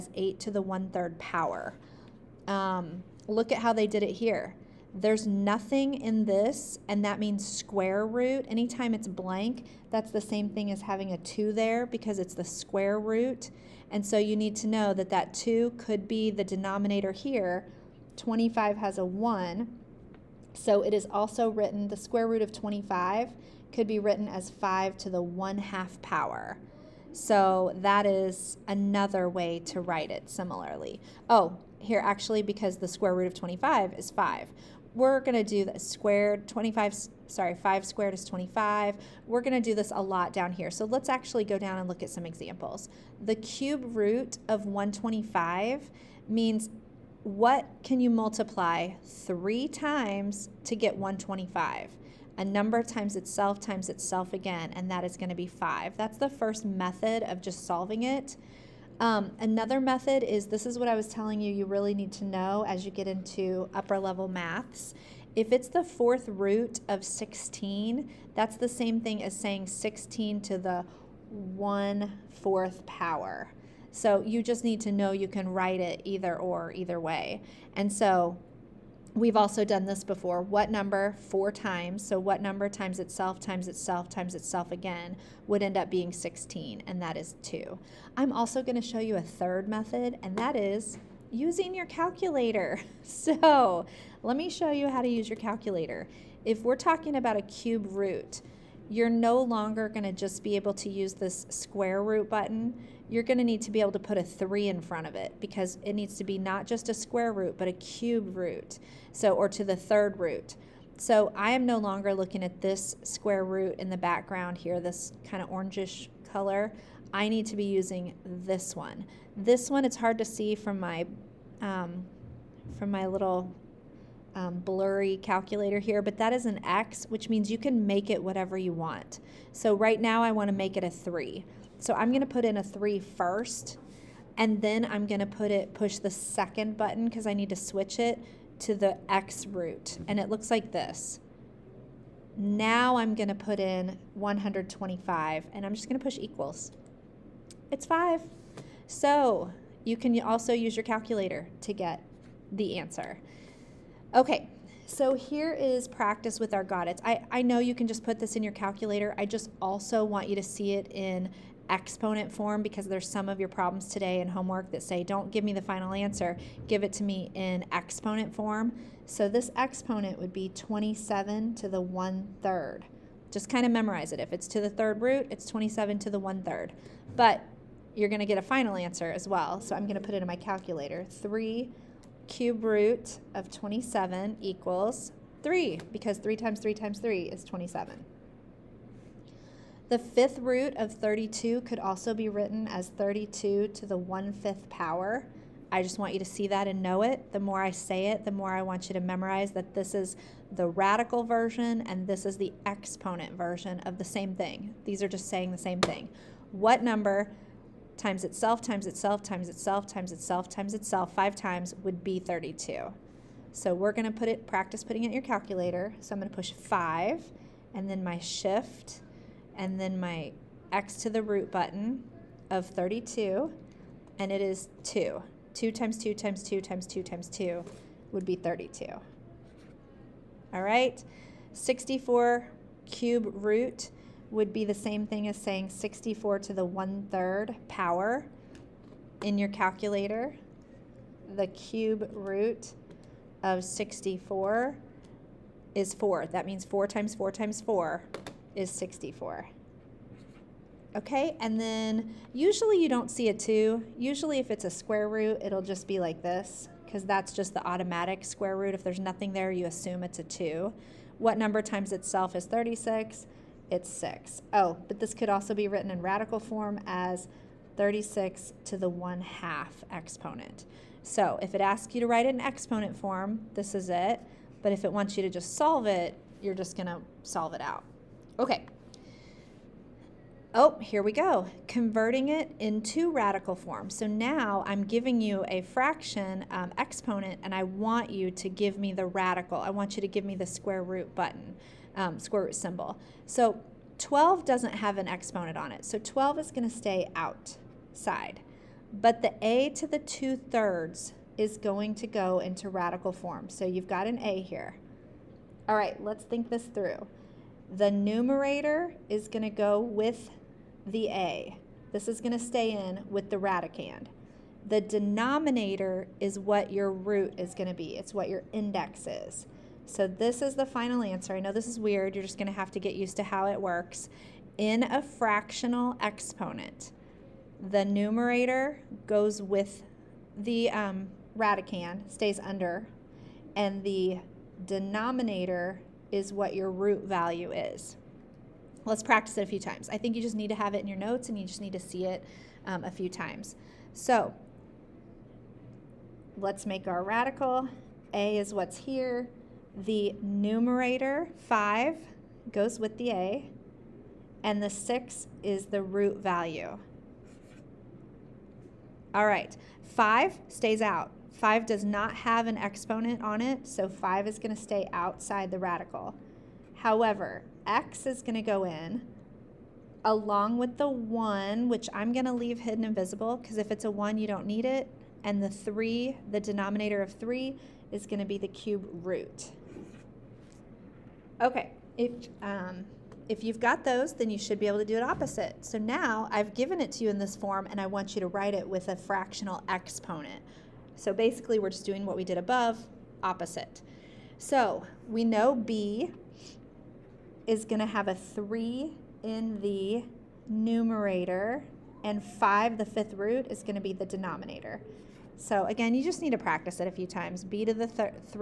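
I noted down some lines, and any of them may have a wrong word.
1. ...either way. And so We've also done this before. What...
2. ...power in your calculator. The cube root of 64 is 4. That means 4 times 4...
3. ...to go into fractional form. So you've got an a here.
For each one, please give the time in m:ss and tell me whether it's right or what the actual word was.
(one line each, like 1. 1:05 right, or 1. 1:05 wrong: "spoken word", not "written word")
1. 1:16 right
2. 3:57 right
3. 5:01 wrong: "radical", not "fractional".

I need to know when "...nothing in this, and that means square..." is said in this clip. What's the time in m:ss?
0:05.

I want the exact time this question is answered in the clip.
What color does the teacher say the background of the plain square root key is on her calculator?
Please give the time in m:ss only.
1:55.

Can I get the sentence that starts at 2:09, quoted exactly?
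So right now I wanna make it a three.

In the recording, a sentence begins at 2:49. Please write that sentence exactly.
So this exponent would be 27 to the 1 third.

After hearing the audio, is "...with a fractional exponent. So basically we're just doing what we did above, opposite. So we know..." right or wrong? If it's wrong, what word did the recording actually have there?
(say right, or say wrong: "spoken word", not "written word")
right.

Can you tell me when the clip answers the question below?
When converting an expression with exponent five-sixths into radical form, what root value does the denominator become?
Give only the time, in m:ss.
5:54.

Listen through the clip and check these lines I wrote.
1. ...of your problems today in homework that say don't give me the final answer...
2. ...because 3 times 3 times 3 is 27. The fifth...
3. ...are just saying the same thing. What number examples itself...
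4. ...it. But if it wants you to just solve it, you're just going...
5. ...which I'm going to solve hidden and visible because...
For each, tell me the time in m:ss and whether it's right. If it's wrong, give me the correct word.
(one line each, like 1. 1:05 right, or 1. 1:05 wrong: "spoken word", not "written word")
1. 2:43 right
2. 3:05 right
3. 3:25 wrong: "times", not "examples"
4. 4:33 right
5. 6:11 wrong: "leave", not "solve".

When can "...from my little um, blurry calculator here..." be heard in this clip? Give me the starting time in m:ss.
2:02.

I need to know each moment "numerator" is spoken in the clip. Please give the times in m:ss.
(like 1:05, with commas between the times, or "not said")
5:07, 5:27, 5:50, 6:40.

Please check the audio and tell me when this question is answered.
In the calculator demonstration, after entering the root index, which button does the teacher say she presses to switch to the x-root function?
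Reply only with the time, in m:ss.
2:16.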